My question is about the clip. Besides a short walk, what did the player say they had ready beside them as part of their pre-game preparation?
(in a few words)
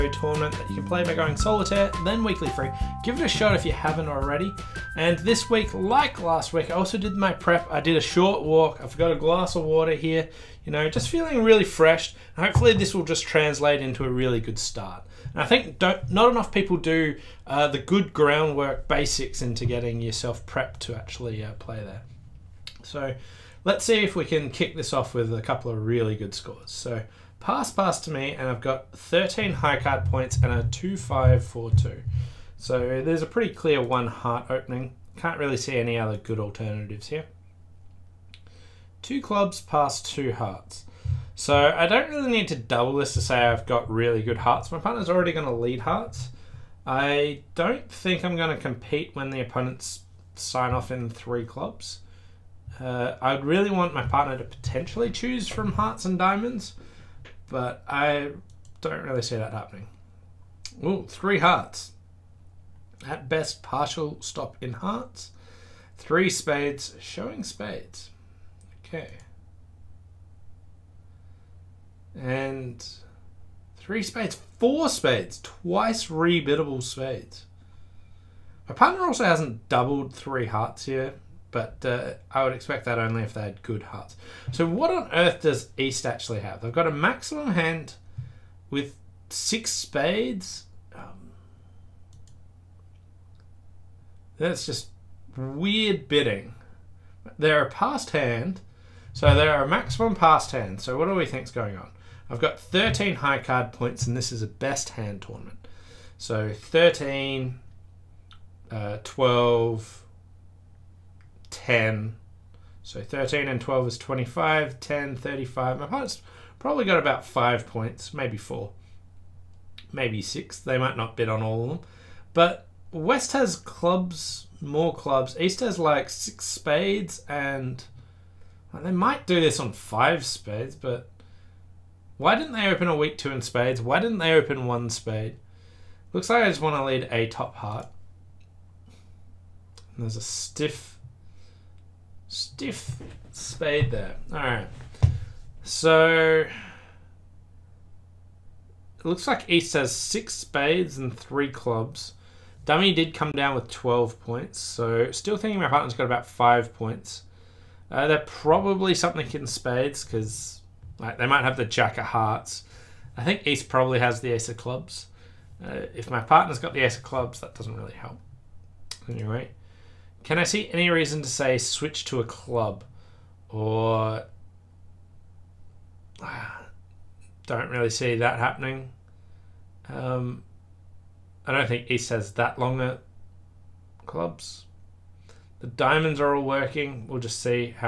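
A glass of water.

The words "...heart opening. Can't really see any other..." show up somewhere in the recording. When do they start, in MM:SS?
00:34.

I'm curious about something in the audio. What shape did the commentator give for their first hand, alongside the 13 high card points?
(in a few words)
2542.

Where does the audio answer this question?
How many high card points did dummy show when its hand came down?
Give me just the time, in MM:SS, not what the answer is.
02:33.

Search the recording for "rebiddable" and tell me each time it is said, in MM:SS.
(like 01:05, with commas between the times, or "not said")
01:16.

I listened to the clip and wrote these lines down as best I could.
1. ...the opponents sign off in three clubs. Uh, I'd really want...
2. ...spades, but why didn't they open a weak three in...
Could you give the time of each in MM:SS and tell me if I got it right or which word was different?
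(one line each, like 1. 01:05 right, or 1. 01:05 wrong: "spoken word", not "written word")
1. 00:49 right
2. 02:10 wrong: "two", not "three".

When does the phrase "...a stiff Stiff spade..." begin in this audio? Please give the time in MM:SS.
02:20.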